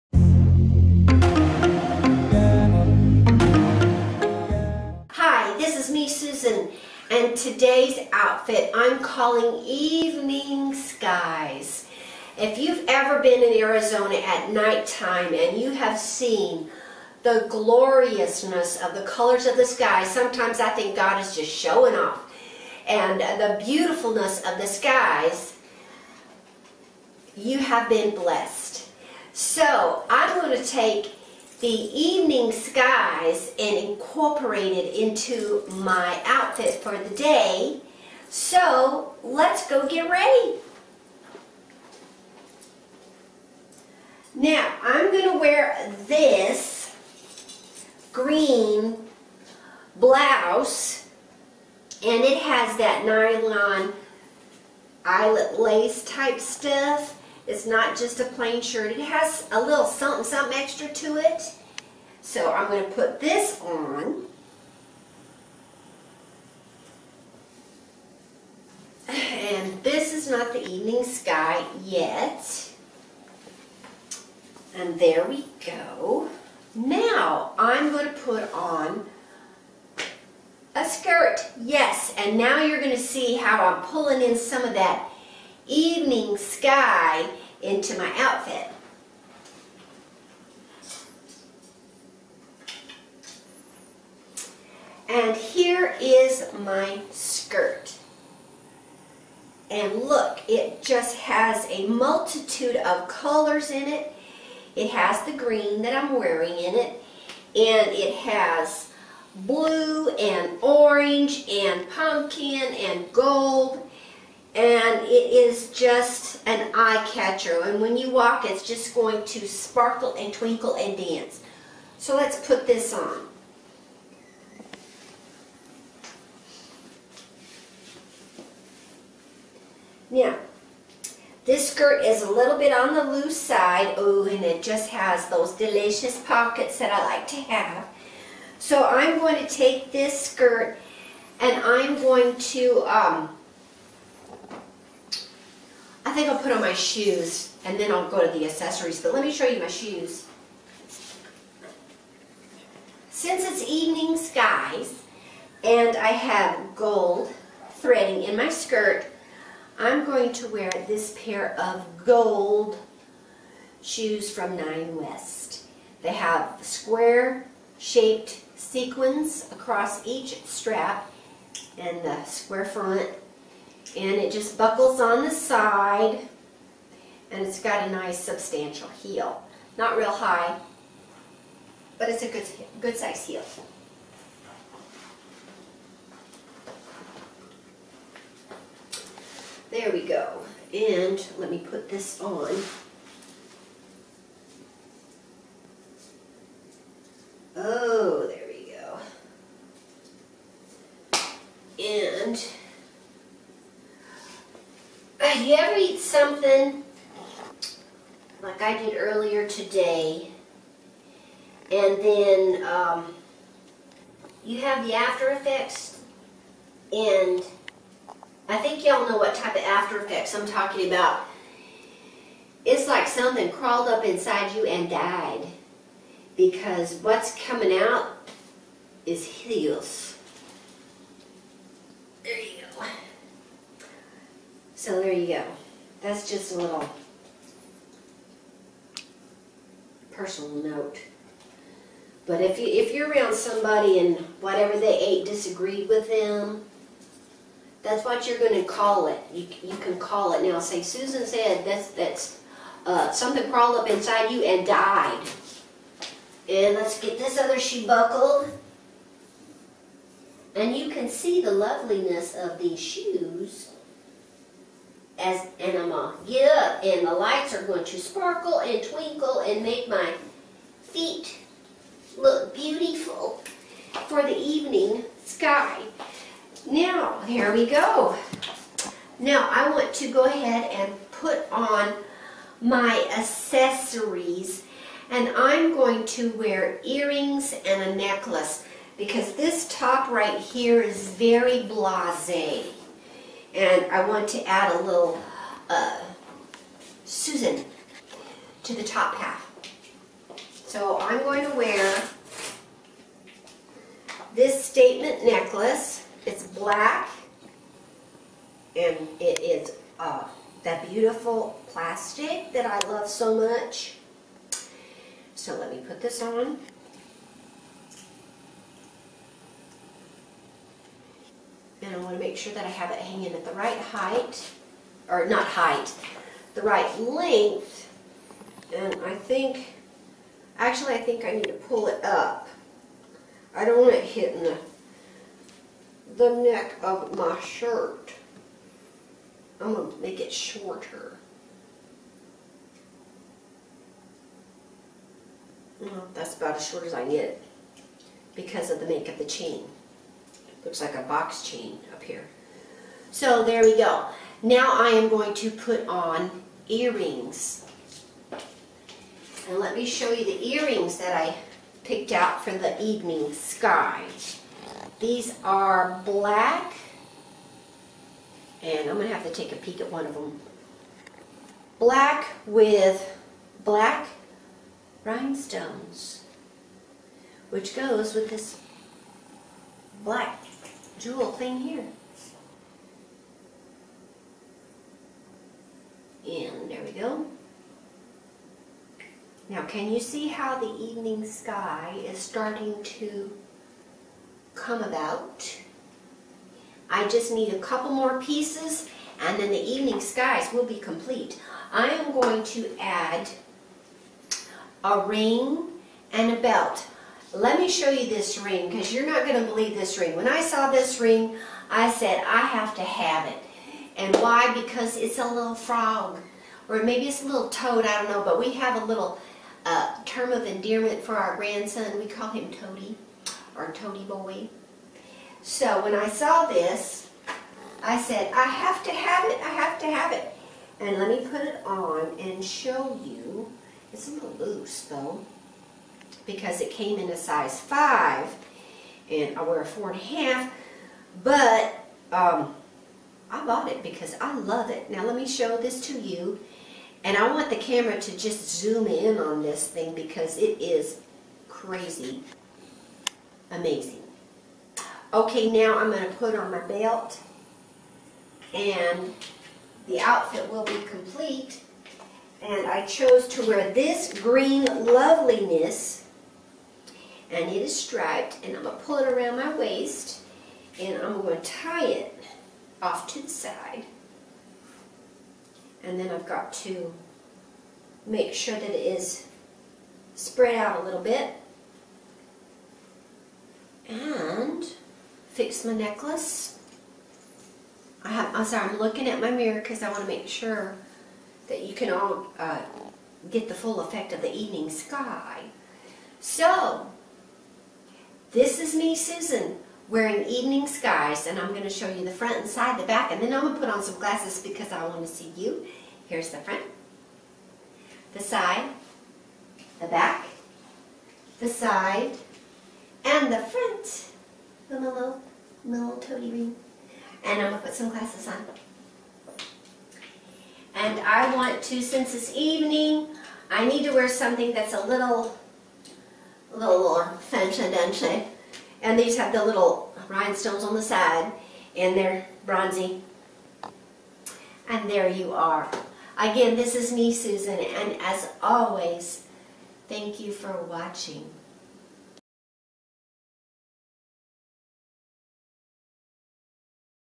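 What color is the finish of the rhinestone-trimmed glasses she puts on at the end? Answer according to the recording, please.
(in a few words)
Bronzy.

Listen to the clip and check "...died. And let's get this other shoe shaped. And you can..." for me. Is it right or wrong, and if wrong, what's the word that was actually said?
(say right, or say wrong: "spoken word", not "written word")
wrong: "buckled", not "shaped".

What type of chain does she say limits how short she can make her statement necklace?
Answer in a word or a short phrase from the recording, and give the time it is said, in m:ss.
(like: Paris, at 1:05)
Box chain, at 5:51.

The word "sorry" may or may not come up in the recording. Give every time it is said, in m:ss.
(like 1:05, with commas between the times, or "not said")
8:08.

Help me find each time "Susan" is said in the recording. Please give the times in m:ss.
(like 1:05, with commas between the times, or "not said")
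4:10, 4:57, 8:18, 8:57.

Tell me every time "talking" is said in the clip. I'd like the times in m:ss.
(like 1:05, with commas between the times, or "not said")
3:40.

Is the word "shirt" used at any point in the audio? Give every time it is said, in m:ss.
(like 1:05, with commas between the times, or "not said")
0:58, 5:37.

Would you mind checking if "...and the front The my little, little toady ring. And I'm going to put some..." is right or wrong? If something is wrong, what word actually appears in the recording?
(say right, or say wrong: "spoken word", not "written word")
right.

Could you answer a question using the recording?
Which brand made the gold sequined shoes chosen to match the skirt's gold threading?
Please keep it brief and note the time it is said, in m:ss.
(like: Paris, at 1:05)
Nine West, at 2:44.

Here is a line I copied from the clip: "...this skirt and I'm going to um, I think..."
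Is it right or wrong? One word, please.
right.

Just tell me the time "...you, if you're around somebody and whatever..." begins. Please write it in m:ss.
4:02.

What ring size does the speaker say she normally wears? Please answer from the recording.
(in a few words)
4 and a half.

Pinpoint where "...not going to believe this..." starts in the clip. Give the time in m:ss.
6:49.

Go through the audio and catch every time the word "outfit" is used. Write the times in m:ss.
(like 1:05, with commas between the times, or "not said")
0:08, 0:36, 1:28, 7:39.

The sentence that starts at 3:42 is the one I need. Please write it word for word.
It's like something crawled up inside you and died because what's coming out is heels.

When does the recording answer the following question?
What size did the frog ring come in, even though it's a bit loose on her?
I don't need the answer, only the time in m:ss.
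7:17.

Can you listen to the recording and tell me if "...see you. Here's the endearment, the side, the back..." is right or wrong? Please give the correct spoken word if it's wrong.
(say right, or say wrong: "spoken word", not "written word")
wrong: "front", not "endearment".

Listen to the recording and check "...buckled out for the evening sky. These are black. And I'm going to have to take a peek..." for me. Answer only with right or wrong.
wrong.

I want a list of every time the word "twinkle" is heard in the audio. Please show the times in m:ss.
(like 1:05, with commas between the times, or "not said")
2:00, 4:28.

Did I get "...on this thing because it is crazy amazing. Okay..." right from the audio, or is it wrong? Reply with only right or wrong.
right.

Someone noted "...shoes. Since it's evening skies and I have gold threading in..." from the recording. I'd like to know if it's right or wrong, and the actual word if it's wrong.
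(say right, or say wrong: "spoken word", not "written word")
right.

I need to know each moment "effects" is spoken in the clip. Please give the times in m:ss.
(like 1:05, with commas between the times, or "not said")
3:35, 3:40, 8:13.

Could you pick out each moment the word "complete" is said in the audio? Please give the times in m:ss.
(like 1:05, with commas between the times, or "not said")
6:40, 7:40.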